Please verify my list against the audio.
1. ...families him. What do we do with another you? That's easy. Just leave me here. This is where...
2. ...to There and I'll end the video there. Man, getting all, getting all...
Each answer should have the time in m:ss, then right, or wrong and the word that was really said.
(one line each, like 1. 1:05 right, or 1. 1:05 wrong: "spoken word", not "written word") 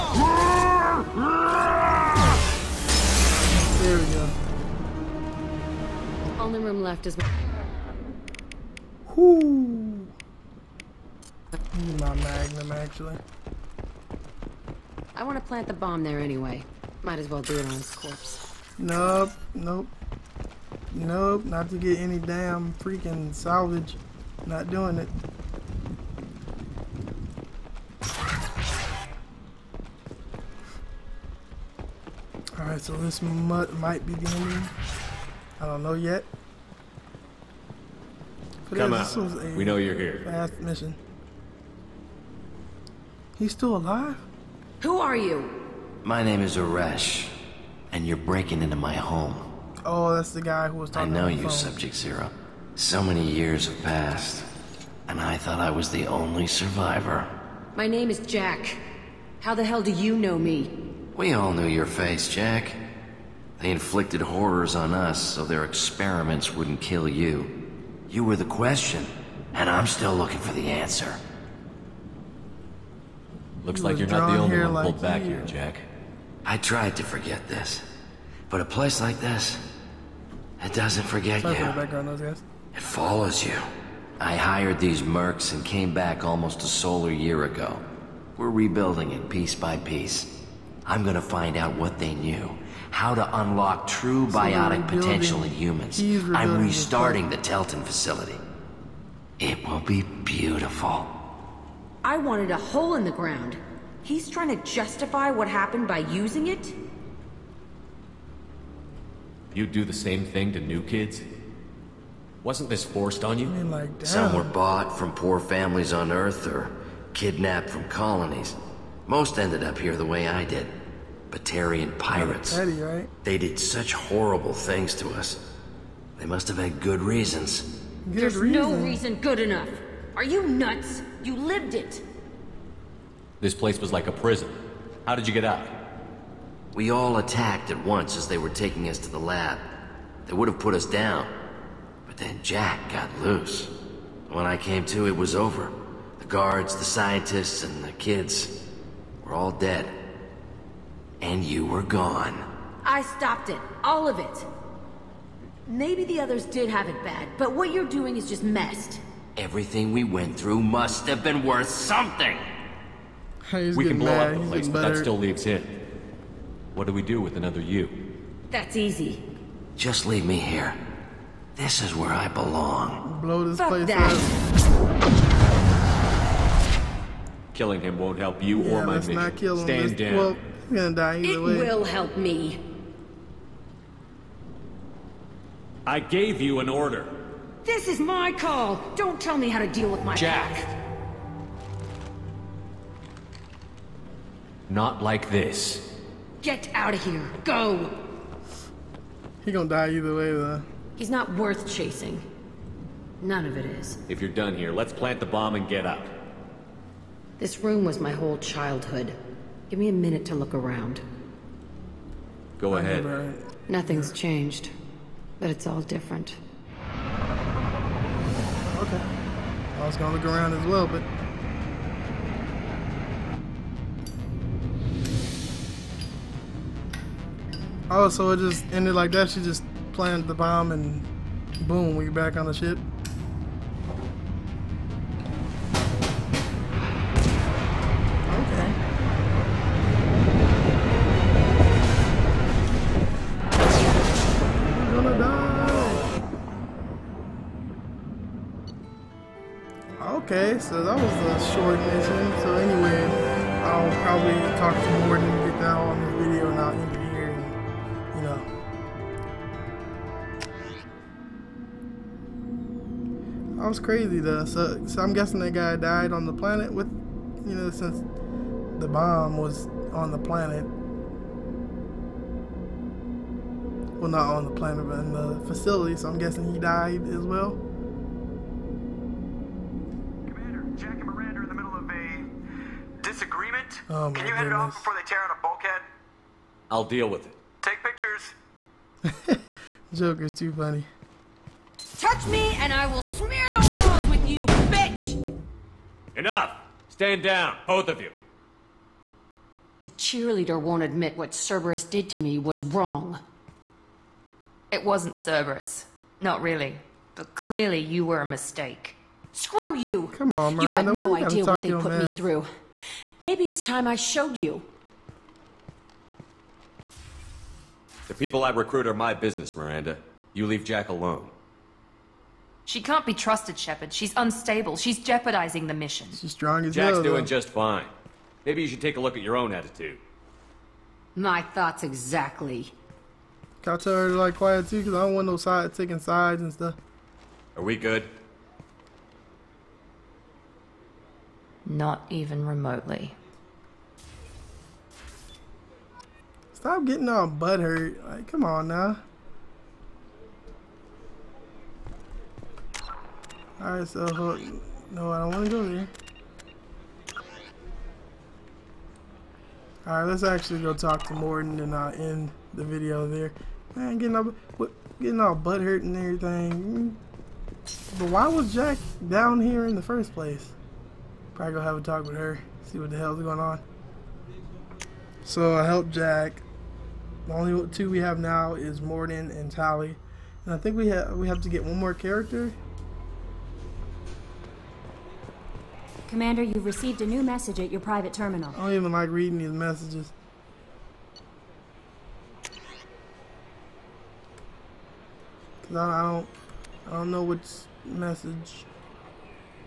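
1. 2:45 wrong: "leaves", not "families"
2. 6:01 wrong: "Mordin", not "There".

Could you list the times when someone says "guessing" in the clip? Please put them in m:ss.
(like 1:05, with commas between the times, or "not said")
4:25, 4:36.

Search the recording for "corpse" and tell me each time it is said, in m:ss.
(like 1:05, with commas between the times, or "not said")
0:17.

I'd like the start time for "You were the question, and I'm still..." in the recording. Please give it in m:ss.
1:08.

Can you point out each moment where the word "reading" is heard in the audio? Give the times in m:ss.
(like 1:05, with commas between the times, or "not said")
6:29.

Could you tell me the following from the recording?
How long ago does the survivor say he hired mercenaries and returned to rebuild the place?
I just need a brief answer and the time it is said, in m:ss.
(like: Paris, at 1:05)
almost a solar year, at 1:26.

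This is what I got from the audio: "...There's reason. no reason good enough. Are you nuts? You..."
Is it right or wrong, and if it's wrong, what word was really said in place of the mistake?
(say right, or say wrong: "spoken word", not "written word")
right.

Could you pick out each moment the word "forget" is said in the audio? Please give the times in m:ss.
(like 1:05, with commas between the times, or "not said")
1:17, 1:21.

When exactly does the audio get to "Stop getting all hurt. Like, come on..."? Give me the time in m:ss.
5:46.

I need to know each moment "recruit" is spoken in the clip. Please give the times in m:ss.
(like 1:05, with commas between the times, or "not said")
5:18.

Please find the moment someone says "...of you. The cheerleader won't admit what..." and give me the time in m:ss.
4:57.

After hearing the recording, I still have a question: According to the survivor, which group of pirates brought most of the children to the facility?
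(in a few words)
Batarian pirates.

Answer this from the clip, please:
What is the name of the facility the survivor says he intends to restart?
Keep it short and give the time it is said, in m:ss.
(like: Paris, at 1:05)
Teltin facility, at 1:37.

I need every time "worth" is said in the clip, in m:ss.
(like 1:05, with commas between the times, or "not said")
2:41, 3:21.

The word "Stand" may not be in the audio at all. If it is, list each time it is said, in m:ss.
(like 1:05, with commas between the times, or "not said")
2:59, 4:56.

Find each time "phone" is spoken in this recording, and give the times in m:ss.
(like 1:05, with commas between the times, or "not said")
0:51.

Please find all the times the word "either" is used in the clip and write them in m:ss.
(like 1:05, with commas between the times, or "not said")
3:01, 3:19.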